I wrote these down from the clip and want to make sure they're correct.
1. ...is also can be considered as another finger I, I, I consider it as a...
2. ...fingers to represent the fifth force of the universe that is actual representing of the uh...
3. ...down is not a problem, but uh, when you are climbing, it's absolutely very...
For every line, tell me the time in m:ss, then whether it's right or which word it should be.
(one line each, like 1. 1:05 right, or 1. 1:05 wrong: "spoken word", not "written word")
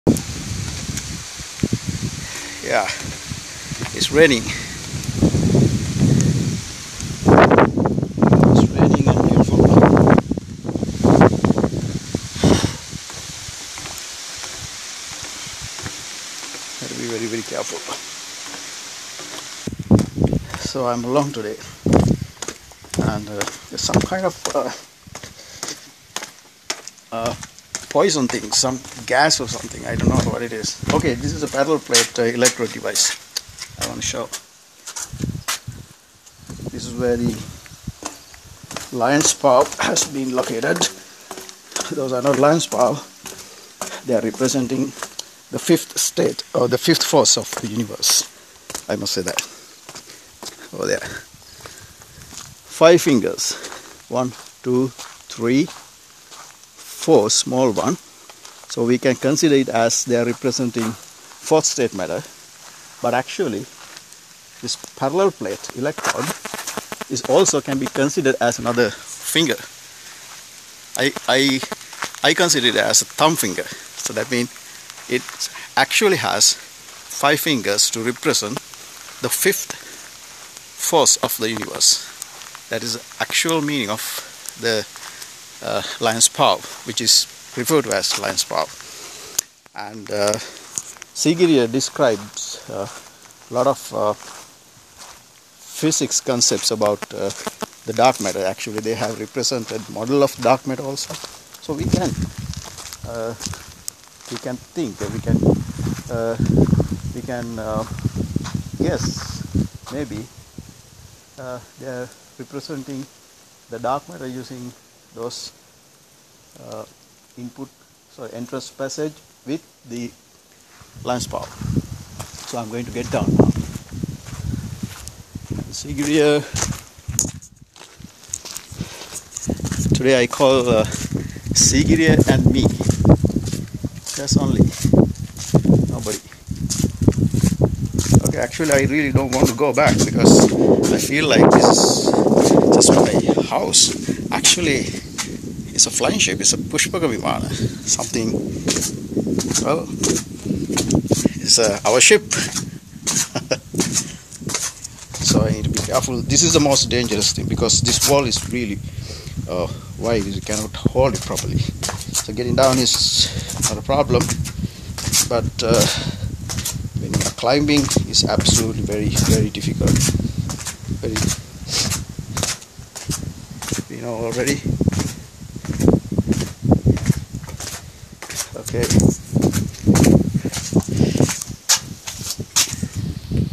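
1. 1:07 right
2. 1:17 wrong: "meaning", not "representing"
3. 2:42 right.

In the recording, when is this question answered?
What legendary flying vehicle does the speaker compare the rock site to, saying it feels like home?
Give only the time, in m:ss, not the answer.
2:26.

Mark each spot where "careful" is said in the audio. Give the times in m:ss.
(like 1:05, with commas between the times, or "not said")
0:17, 2:35.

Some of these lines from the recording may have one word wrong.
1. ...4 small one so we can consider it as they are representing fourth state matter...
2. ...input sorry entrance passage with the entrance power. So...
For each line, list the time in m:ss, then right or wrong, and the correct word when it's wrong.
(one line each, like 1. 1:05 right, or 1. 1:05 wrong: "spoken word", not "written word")
1. 0:57 right
2. 1:57 wrong: "lance", not "entrance".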